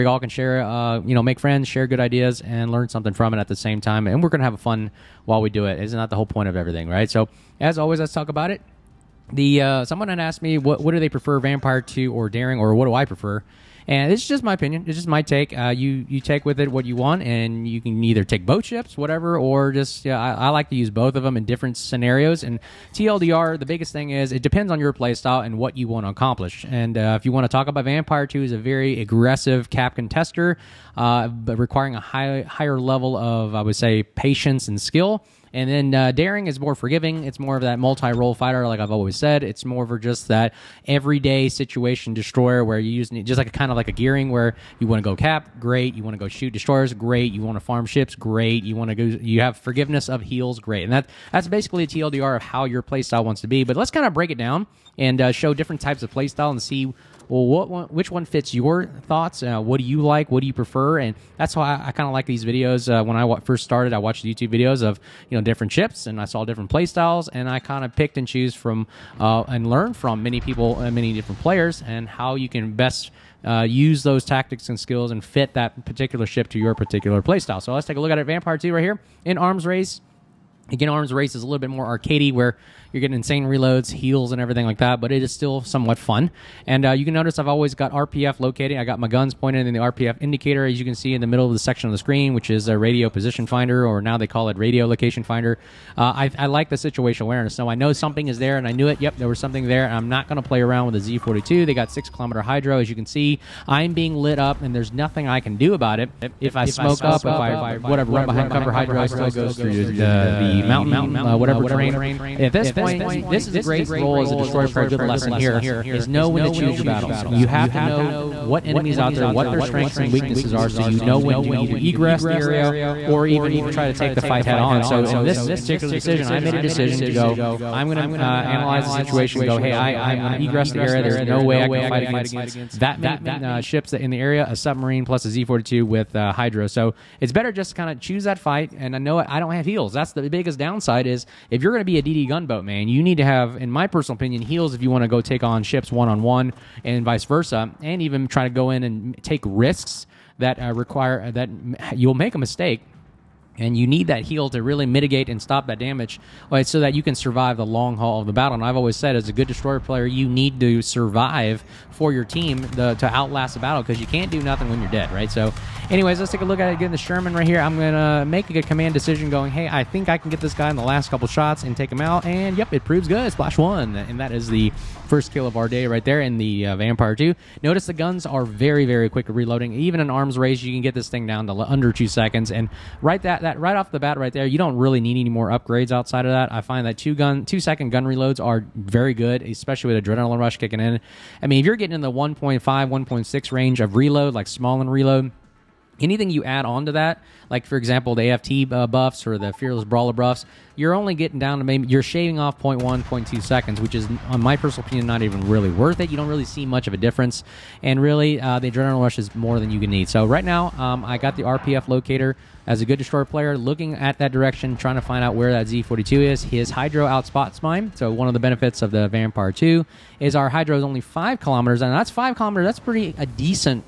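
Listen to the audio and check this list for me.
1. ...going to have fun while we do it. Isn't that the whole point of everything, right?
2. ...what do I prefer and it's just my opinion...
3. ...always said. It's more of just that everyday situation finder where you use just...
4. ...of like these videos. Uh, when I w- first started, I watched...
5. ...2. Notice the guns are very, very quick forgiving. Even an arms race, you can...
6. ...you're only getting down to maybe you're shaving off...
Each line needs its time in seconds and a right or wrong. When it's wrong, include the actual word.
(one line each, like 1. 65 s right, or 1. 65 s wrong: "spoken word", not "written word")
1. 4 s right
2. 12 s right
3. 38 s wrong: "destroyer", not "finder"
4. 62 s right
5. 177 s wrong: "reloading", not "forgiving"
6. 200 s right.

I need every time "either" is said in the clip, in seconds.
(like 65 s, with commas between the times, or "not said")
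18 s, 121 s.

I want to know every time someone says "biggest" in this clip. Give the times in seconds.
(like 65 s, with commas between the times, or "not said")
23 s, 140 s.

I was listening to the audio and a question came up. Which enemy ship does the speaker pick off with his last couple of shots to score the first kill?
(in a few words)
Sherman.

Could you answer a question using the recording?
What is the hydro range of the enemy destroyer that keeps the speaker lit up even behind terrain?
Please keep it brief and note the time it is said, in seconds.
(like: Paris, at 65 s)
6 km, at 101 s.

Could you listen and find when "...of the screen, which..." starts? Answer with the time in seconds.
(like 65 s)
91 s.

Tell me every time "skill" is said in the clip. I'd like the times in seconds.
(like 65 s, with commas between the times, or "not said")
34 s, 74 s.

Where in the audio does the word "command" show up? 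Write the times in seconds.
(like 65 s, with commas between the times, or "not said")
168 s.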